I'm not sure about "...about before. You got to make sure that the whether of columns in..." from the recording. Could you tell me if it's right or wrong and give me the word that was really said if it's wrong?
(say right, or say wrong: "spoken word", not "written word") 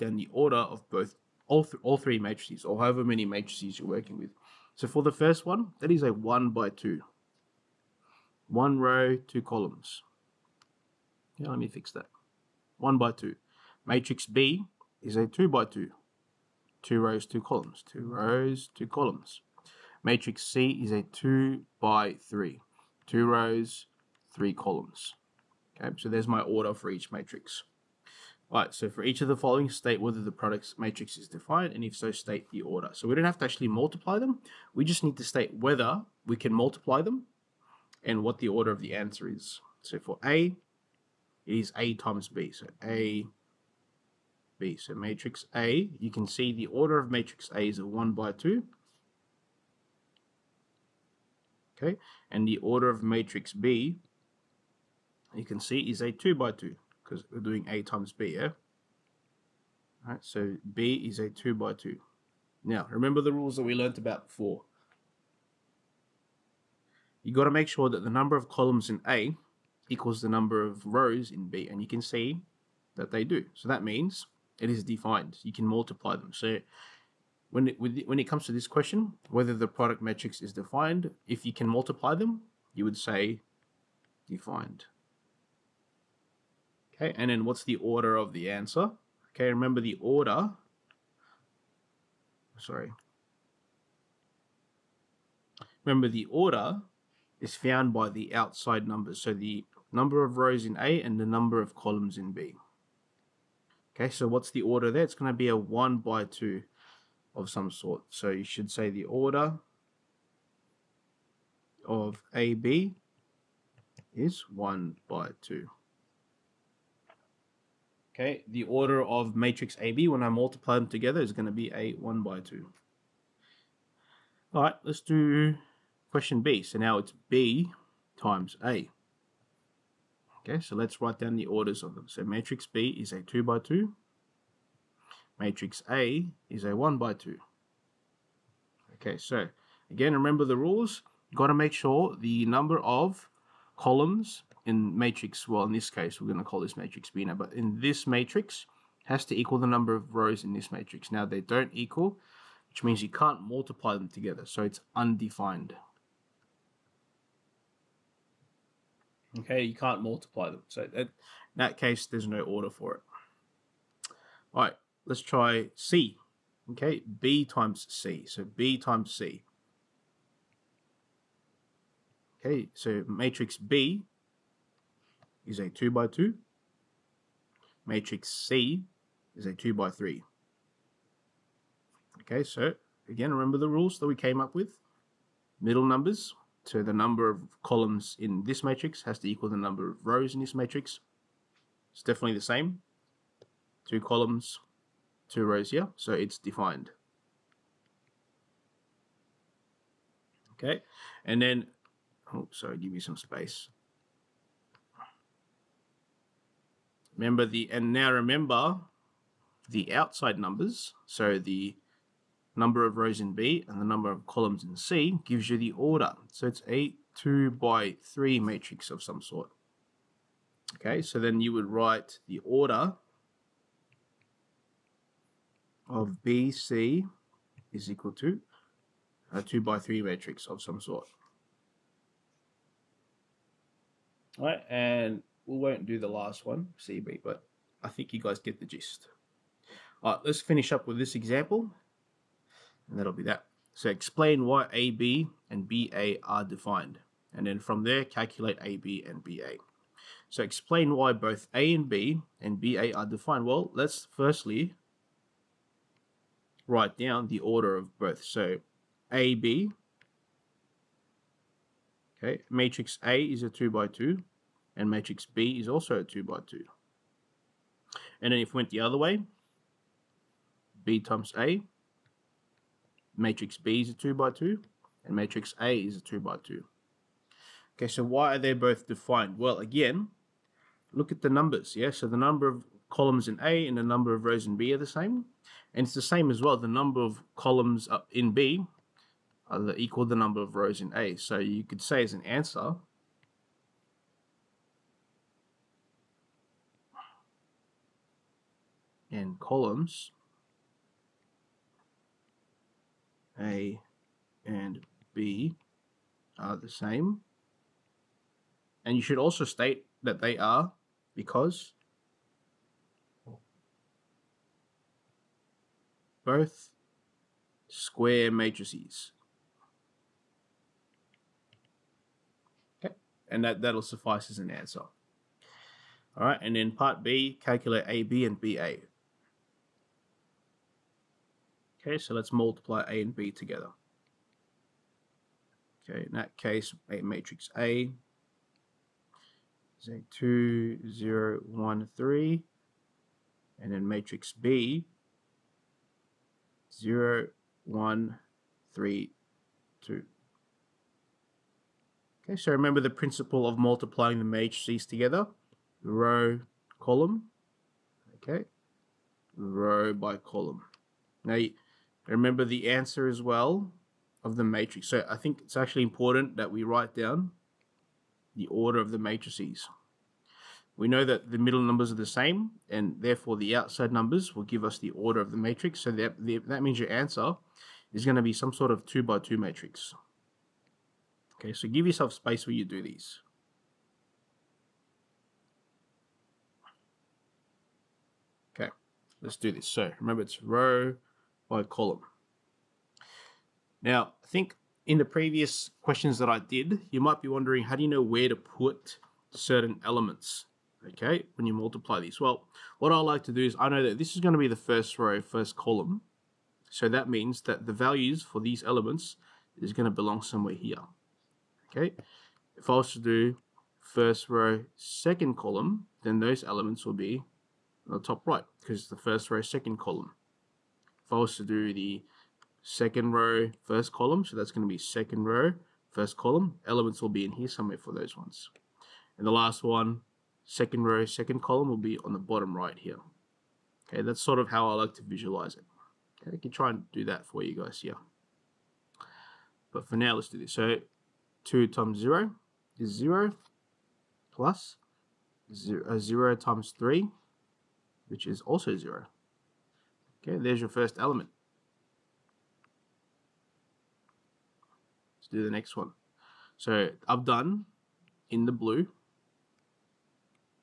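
wrong: "number", not "whether".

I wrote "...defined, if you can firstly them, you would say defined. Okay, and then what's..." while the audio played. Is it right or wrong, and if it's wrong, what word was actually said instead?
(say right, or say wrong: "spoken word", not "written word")
wrong: "multiply", not "firstly".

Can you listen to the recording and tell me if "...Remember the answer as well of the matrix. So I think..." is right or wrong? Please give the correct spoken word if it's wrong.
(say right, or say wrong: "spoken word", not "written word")
right.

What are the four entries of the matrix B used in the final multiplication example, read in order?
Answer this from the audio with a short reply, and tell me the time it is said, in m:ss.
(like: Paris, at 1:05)
0, 1, 3, 2, at 5:46.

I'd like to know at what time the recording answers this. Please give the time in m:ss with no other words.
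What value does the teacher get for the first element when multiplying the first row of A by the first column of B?
7:25.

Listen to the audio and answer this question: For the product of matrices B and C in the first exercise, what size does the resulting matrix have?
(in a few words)
2 by 3.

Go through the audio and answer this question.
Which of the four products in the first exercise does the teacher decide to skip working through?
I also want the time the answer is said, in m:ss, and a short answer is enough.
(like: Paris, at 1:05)
CB, at 3:55.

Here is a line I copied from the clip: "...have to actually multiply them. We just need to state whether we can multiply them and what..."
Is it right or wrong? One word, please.
right.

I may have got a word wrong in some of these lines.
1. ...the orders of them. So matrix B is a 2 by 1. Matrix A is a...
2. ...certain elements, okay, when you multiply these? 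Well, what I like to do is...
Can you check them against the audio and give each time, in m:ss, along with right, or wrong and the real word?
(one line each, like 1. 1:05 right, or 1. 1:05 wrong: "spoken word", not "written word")
1. 2:11 wrong: "2", not "1"
2. 6:39 right.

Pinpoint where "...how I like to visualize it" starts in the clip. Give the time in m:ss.
7:14.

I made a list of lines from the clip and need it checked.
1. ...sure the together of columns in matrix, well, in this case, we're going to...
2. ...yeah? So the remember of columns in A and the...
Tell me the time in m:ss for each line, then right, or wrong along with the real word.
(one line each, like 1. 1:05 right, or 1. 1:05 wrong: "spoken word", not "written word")
1. 2:21 wrong: "number", not "together"
2. 4:41 wrong: "number", not "remember".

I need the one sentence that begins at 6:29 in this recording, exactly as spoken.
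So remember it's row, by column.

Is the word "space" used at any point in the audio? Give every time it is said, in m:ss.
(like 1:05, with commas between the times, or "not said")
3:23, 6:22.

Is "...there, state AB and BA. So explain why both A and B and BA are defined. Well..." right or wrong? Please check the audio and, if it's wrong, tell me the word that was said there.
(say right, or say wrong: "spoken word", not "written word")
wrong: "calculate", not "state".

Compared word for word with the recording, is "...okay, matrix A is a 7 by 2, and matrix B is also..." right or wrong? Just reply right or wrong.
wrong.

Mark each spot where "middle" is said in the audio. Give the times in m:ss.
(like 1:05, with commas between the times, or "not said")
3:05, 6:11.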